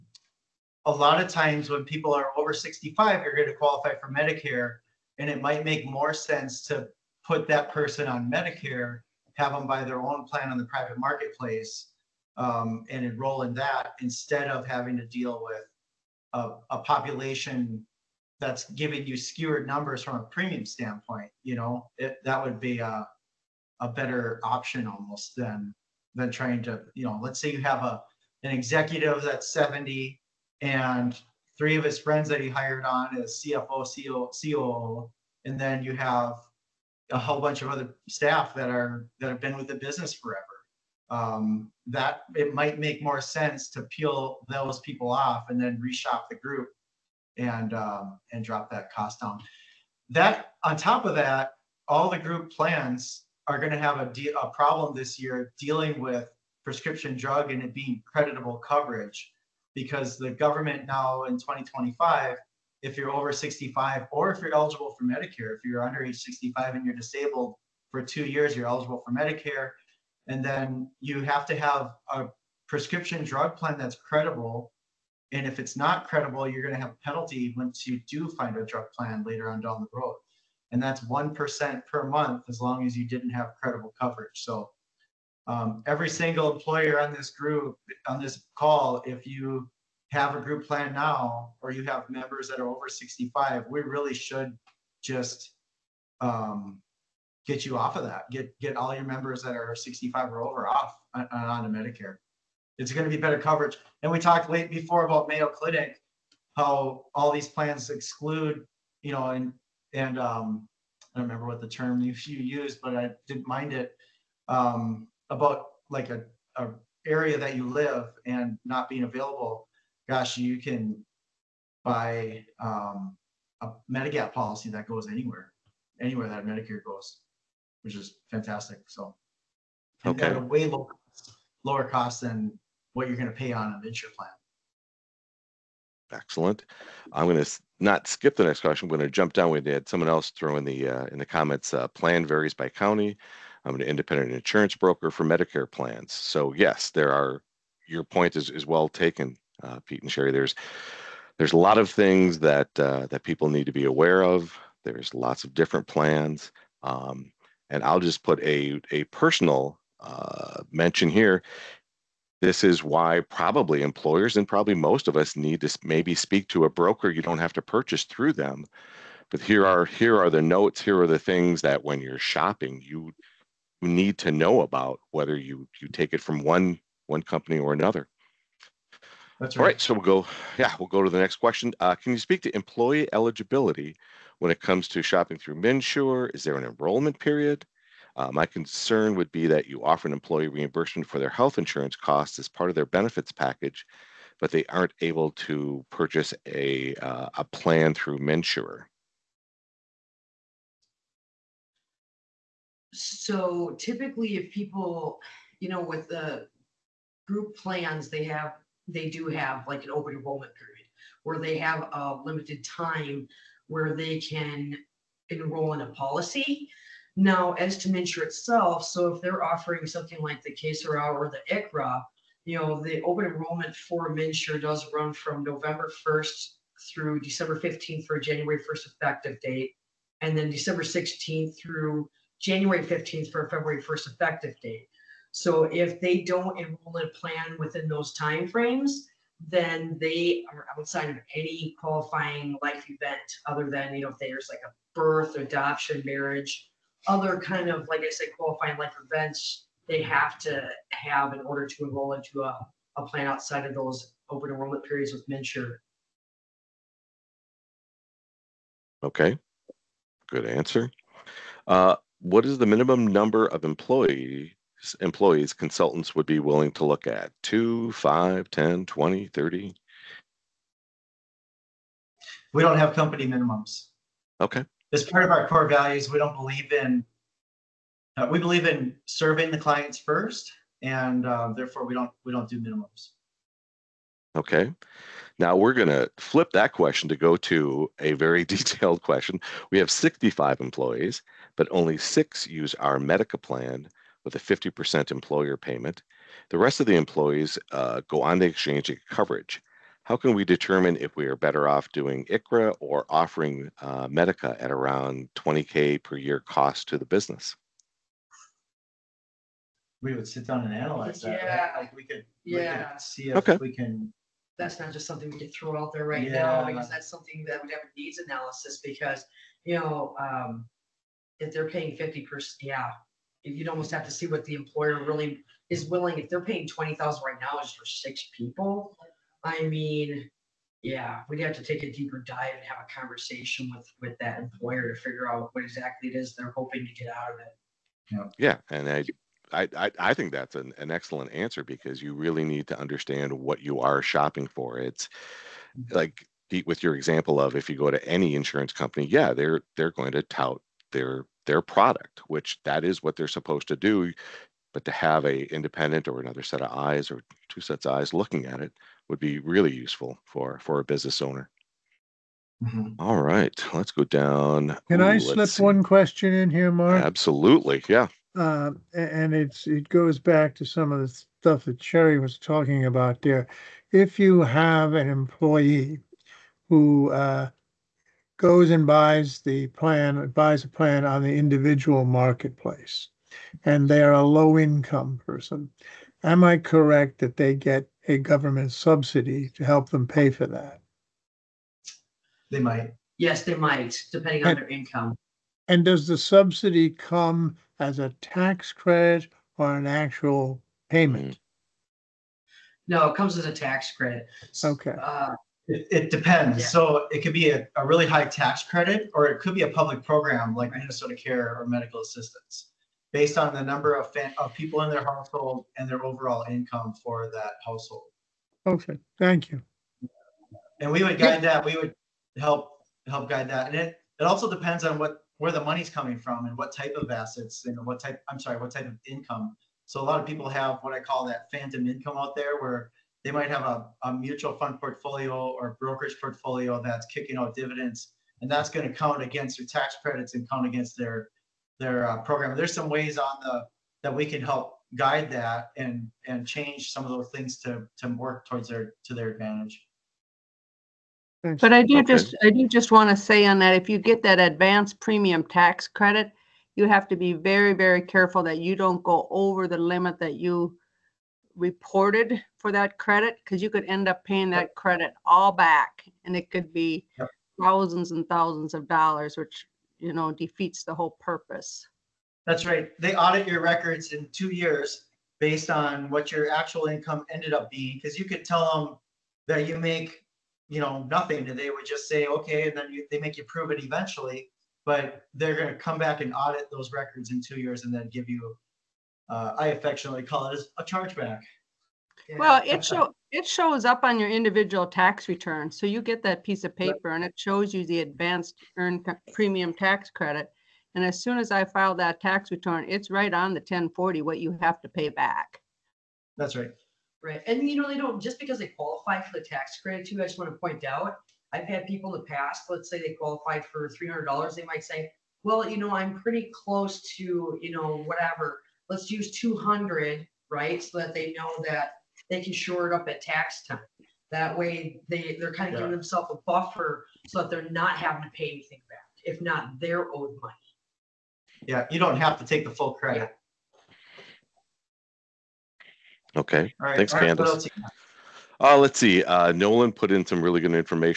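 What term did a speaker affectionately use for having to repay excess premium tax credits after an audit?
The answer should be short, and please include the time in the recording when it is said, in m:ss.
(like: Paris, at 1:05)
Chargeback, at 8:10.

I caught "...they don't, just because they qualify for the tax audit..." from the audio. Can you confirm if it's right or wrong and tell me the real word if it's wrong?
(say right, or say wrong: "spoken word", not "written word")
wrong: "credit", not "audit".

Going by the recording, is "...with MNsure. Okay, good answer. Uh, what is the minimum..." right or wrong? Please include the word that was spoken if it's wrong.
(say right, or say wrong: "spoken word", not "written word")
right.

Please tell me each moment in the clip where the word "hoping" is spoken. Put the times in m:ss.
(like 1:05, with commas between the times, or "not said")
5:36.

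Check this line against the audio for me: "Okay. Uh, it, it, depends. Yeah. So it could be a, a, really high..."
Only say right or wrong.
right.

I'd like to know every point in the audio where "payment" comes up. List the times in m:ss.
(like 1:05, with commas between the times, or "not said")
4:55, 6:40.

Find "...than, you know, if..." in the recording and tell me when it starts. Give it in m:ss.
4:03.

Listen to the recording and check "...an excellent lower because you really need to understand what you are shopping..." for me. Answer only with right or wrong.
wrong.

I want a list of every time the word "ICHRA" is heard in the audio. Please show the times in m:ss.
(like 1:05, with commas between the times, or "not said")
3:41, 5:02.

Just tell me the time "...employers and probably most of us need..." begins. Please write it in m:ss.
2:43.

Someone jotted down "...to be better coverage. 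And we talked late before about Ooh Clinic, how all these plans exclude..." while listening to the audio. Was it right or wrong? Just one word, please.
wrong.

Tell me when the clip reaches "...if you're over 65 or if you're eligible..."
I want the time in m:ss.
1:02.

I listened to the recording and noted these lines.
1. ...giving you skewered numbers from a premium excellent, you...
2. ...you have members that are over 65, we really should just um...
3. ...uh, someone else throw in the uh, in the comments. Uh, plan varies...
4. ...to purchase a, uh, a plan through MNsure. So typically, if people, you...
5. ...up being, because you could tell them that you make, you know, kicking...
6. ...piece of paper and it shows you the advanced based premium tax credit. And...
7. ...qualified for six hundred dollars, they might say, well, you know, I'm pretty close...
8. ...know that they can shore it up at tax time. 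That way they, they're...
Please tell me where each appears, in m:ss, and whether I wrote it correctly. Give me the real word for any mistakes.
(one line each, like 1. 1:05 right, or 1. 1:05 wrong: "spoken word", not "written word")
1. 0:18 wrong: "standpoint", not "excellent"
2. 1:31 right
3. 2:19 right
4. 3:15 right
5. 7:57 wrong: "nothing", not "kicking"
6. 8:16 wrong: "earned", not "based"
7. 8:33 wrong: "three", not "six"
8. 8:41 right.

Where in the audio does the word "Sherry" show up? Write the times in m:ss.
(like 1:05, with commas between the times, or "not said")
2:30, 6:11.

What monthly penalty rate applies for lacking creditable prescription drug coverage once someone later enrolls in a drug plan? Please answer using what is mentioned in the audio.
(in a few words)
1% per month.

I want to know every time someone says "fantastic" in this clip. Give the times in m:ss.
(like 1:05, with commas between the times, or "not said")
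2:08.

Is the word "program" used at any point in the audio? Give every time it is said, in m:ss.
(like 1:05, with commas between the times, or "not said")
6:50, 7:22.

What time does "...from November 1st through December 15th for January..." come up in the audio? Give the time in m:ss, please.
3:45.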